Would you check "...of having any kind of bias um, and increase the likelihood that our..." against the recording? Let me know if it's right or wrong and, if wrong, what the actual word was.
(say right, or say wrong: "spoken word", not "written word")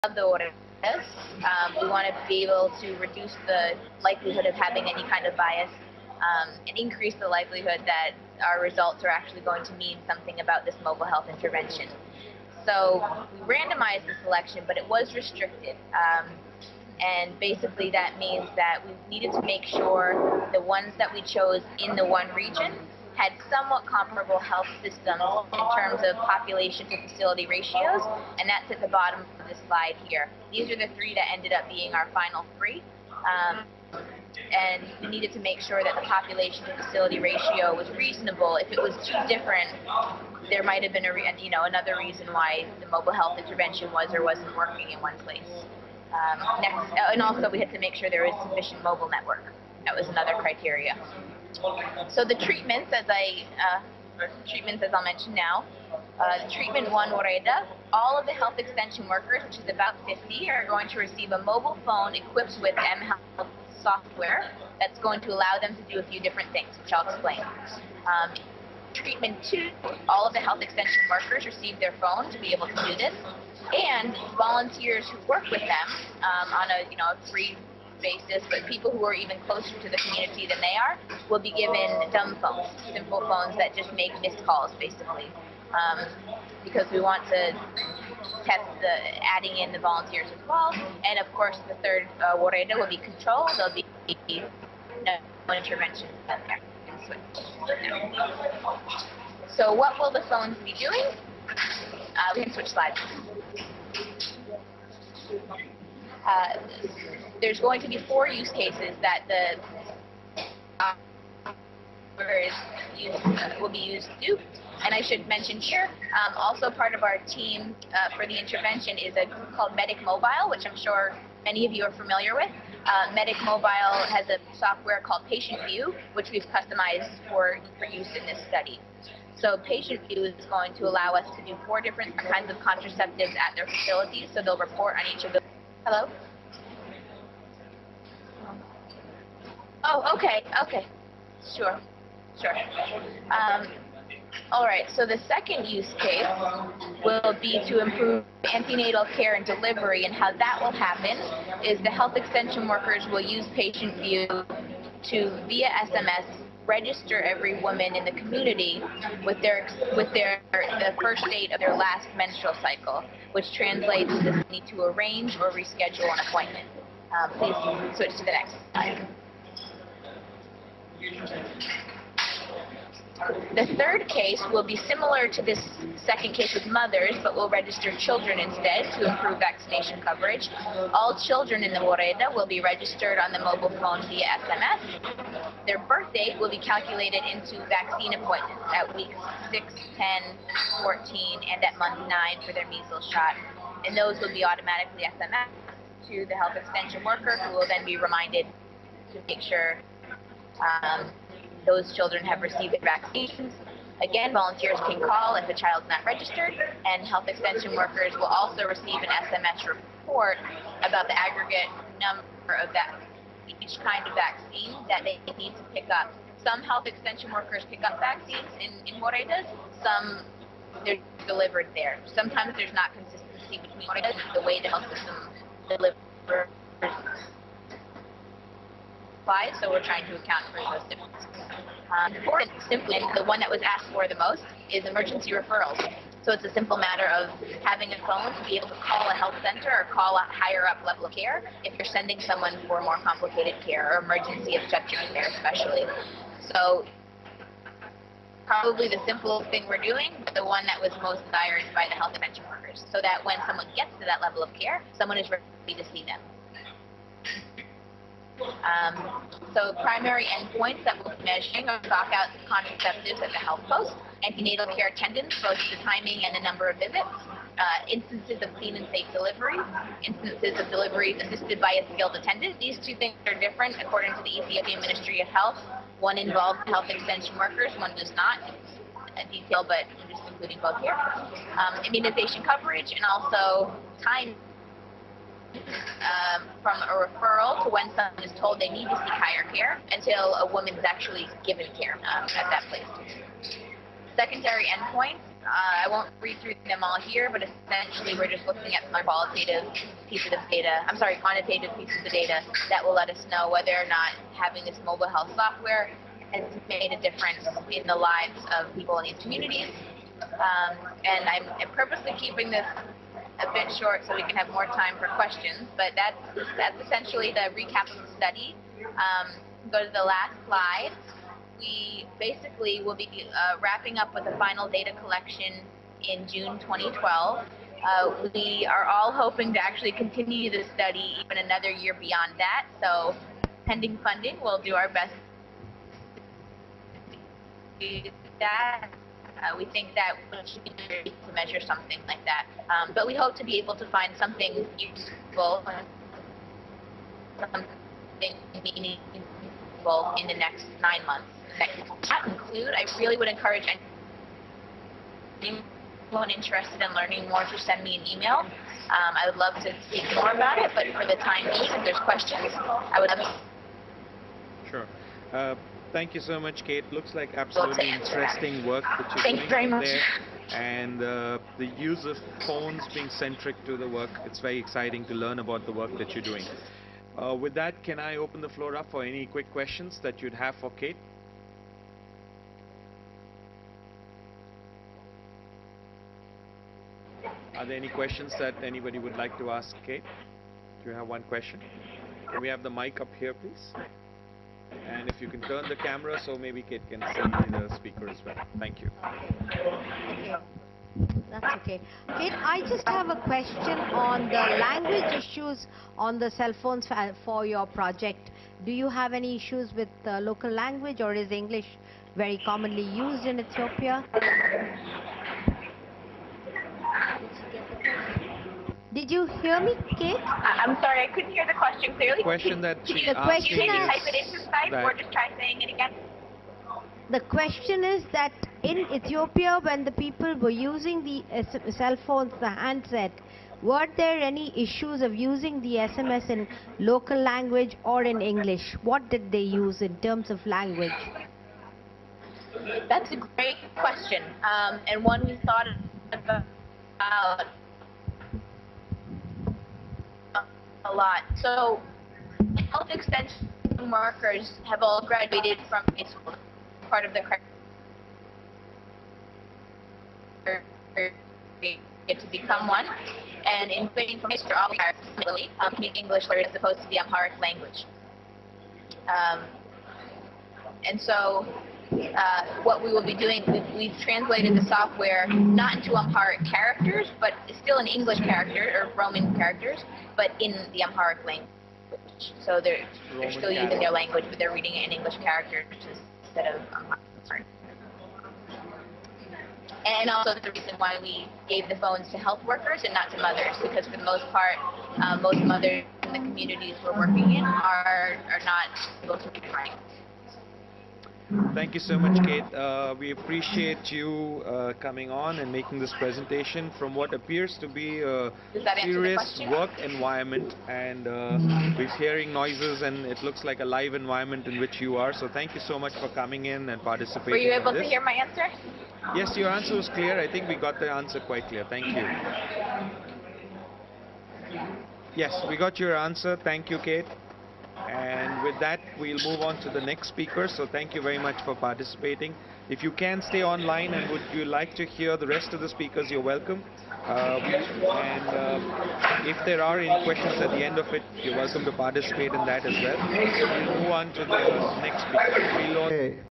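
right.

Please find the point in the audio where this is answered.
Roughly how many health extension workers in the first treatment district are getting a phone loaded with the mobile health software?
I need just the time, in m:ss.
0:59.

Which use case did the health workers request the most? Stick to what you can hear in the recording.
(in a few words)
emergency referrals.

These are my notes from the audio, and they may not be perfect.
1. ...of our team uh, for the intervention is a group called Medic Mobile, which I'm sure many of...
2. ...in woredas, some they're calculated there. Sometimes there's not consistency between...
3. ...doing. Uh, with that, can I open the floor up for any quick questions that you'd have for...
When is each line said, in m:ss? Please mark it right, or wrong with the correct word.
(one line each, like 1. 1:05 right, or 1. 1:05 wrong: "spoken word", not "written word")
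1. 1:56 right
2. 3:38 wrong: "delivered", not "calculated"
3. 6:16 right.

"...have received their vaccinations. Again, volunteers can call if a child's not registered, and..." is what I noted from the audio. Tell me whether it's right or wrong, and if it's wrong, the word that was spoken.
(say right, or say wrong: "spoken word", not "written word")
right.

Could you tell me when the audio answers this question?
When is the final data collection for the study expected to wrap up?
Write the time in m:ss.
5:26.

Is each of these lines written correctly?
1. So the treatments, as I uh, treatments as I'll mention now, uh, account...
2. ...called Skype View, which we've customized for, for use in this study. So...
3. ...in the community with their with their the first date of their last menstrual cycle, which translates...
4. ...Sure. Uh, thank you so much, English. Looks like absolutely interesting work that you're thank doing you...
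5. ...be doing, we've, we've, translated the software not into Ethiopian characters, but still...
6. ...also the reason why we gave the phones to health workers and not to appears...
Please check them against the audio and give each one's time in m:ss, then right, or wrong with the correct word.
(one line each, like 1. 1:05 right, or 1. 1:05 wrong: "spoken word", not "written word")
1. 0:52 wrong: "treatment", not "account"
2. 2:05 wrong: "Patient", not "Skype"
3. 2:37 right
4. 6:04 wrong: "Kate", not "English"
5. 7:53 wrong: "Amharic", not "Ethiopian"
6. 8:10 wrong: "mothers", not "appears".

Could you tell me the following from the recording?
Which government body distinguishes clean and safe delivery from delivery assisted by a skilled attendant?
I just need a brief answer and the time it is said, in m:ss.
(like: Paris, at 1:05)
Ethiopian Ministry of Health, at 4:34.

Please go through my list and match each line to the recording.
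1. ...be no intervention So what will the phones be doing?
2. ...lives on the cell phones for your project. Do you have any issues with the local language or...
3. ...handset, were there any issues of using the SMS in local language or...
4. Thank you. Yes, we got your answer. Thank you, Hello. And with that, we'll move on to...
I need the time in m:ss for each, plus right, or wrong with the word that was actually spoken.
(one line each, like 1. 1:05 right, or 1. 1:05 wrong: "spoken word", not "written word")
1. 1:33 right
2. 6:45 wrong: "issues", not "lives"
3. 7:12 right
4. 8:41 wrong: "Kate", not "Hello".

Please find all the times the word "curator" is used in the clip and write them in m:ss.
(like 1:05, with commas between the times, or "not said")
not said.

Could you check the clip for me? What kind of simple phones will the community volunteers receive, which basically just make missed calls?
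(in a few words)
dumb phones.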